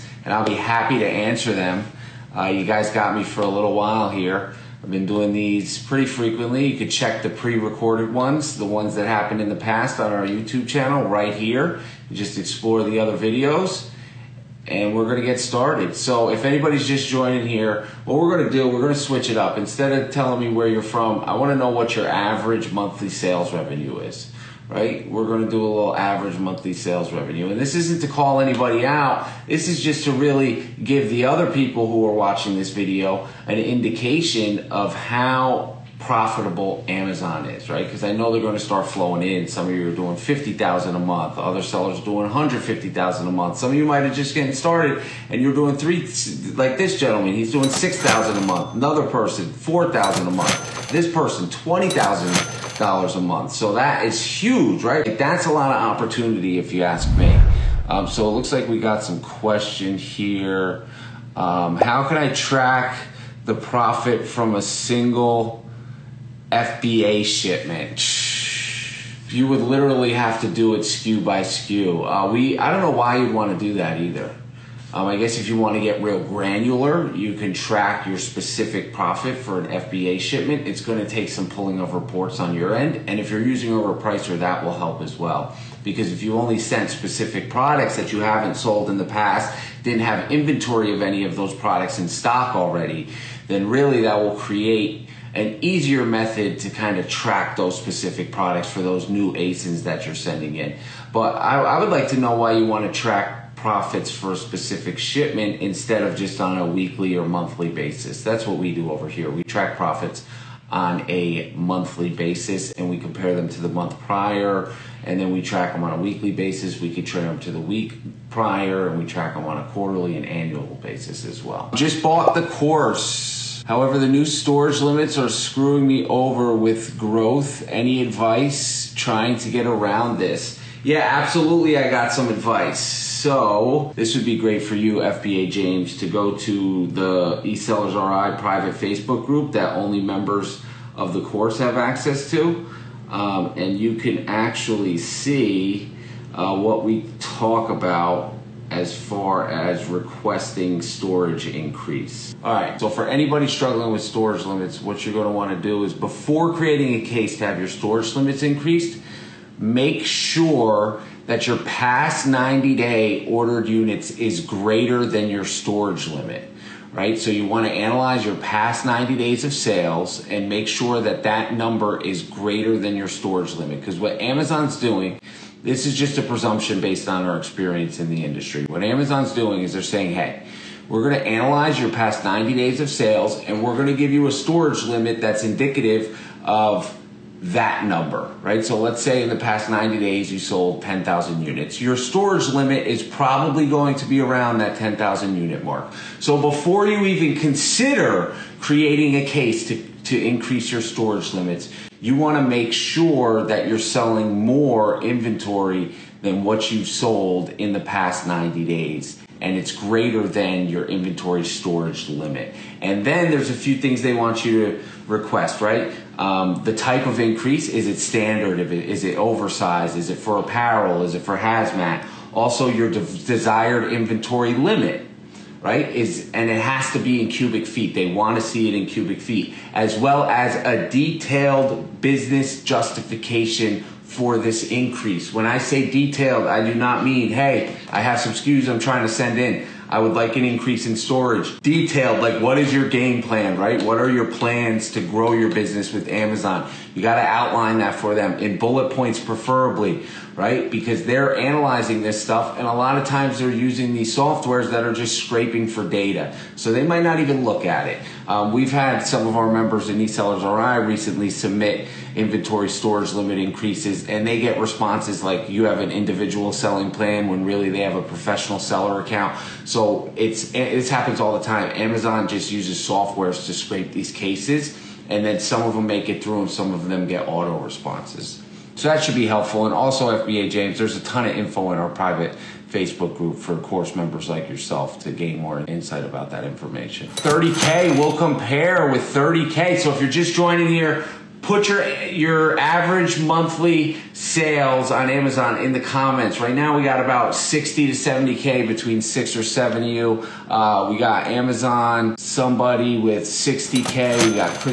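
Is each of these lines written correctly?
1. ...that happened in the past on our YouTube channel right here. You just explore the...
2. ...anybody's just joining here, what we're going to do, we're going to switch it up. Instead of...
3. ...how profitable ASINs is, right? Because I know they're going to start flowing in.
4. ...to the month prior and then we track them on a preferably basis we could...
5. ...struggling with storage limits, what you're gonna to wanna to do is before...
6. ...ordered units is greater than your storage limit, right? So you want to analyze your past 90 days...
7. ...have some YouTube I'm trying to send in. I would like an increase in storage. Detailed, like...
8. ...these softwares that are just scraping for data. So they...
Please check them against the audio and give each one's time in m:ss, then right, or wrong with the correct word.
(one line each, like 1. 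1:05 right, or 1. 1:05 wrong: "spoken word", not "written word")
1. 0:08 right
2. 0:16 right
3. 0:34 wrong: "Amazon", not "ASINs"
4. 1:53 wrong: "weekly", not "preferably"
5. 2:33 right
6. 2:43 right
7. 3:57 wrong: "SKUs", not "YouTube"
8. 4:13 right.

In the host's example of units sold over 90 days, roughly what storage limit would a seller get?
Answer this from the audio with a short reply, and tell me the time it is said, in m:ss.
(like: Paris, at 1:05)
10,000 units, at 3:14.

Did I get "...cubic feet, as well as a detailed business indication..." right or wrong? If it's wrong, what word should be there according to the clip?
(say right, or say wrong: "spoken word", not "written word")
wrong: "justification", not "indication".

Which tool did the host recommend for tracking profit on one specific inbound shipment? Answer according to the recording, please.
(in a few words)
overpricer.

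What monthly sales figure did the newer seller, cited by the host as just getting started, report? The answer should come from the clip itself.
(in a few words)
$6,000.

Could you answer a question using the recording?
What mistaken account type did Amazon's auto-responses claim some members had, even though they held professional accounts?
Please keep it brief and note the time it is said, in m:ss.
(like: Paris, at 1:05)
individual selling plan, at 4:25.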